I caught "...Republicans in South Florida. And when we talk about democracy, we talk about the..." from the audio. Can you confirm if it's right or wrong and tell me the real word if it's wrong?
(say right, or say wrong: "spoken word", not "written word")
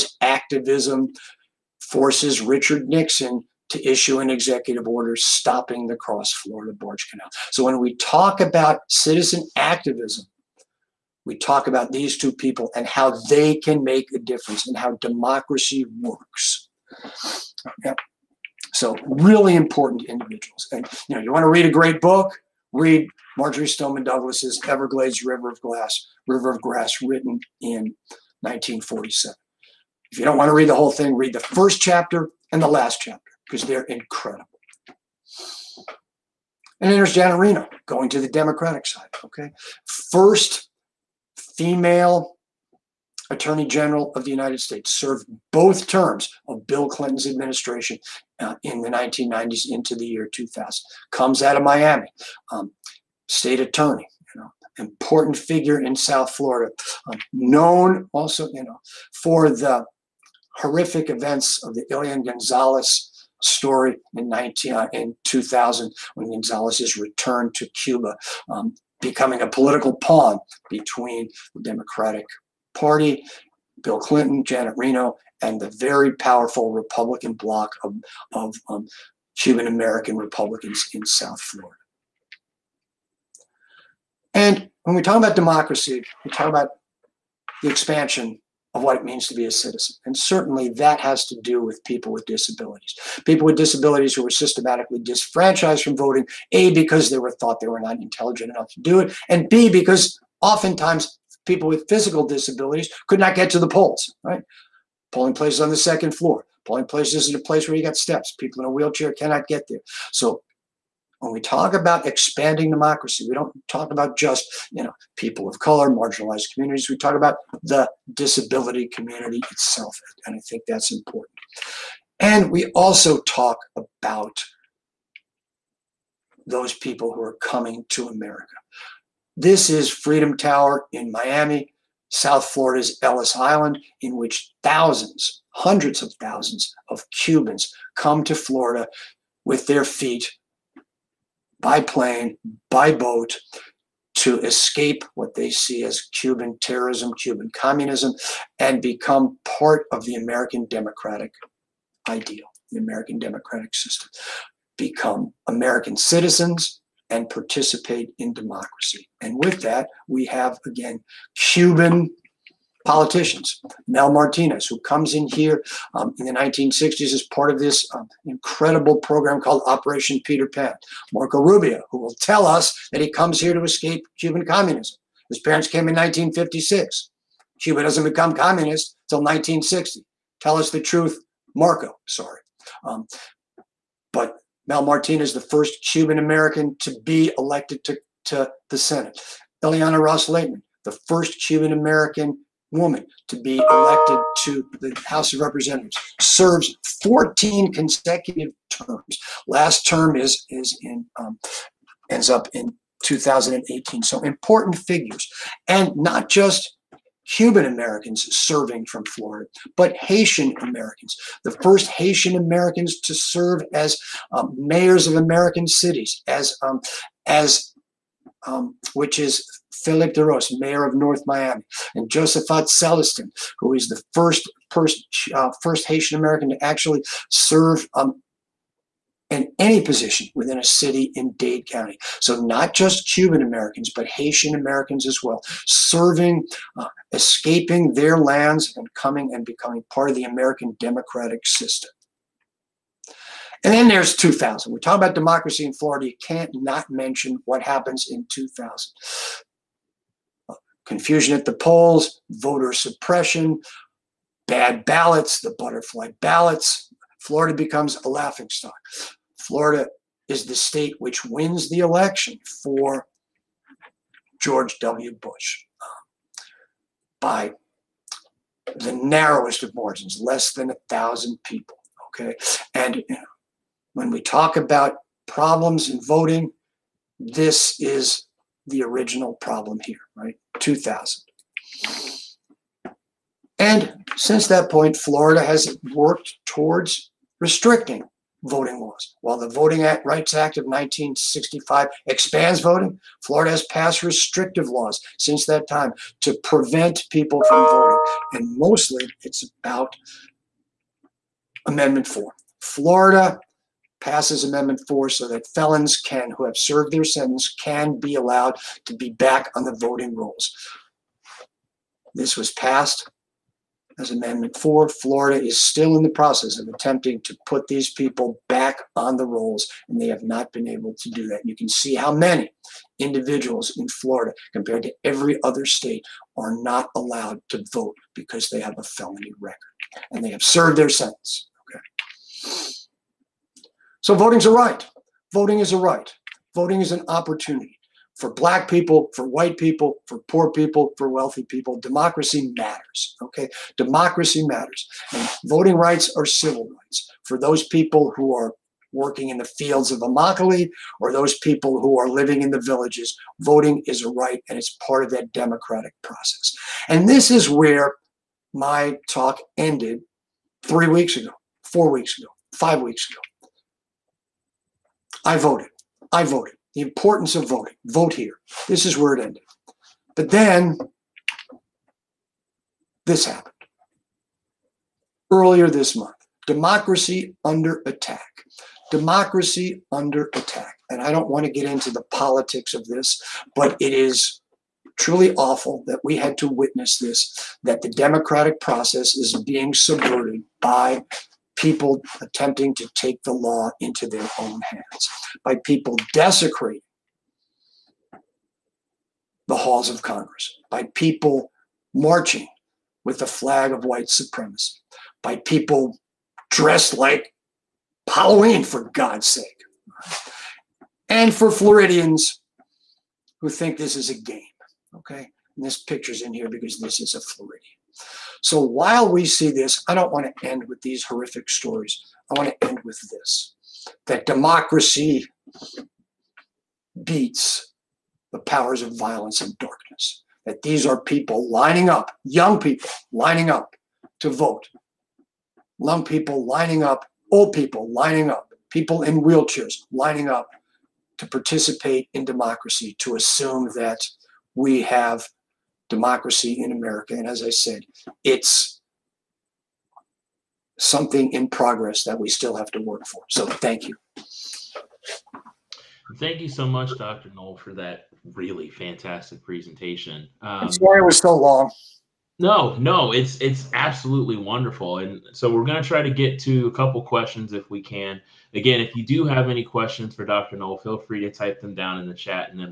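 right.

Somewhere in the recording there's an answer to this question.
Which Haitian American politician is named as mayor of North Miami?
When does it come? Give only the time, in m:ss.
3:39.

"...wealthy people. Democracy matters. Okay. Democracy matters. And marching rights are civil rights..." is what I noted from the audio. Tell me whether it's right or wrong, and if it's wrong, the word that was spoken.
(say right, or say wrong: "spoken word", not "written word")
wrong: "voting", not "marching".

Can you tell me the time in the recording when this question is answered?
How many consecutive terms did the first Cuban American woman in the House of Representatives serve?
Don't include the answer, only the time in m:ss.
3:17.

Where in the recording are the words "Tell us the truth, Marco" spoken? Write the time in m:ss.
3:00.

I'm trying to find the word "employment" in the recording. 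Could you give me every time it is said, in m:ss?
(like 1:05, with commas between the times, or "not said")
not said.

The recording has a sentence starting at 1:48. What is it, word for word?
People in a wheelchair cannot get there.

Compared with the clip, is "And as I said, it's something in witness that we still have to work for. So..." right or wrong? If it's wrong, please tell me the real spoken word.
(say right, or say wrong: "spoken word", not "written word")
wrong: "progress", not "witness".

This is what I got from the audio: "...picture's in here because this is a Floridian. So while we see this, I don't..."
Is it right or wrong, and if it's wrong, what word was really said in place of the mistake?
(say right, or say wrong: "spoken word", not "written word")
right.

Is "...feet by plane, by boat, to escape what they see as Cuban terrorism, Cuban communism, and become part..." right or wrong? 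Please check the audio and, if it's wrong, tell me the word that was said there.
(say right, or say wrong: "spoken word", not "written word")
right.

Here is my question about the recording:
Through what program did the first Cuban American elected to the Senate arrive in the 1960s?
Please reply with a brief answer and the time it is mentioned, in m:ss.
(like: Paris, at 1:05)
Operation Peter Pan, at 2:49.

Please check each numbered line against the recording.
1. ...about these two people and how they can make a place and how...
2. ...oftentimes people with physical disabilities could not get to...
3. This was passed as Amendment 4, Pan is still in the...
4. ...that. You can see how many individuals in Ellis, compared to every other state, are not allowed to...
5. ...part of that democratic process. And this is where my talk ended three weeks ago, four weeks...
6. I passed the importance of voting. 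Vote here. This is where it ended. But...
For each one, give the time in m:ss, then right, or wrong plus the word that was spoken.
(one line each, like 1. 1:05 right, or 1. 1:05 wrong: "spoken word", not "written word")
1. 0:11 wrong: "difference", not "place"
2. 1:40 right
3. 5:12 wrong: "Florida", not "Pan"
4. 5:21 wrong: "Florida", not "Ellis"
5. 5:54 right
6. 6:06 wrong: "voted", not "passed".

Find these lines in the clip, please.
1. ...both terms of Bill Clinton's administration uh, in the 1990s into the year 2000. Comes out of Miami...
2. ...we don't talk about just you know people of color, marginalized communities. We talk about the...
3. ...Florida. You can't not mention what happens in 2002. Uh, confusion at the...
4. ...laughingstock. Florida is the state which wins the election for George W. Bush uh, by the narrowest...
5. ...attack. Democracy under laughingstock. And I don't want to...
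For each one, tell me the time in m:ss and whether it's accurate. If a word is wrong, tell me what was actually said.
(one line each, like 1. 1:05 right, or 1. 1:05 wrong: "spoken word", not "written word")
1. 0:45 right
2. 1:53 right
3. 4:05 wrong: "2000", not "2002"
4. 4:18 right
5. 6:17 wrong: "attack", not "laughingstock".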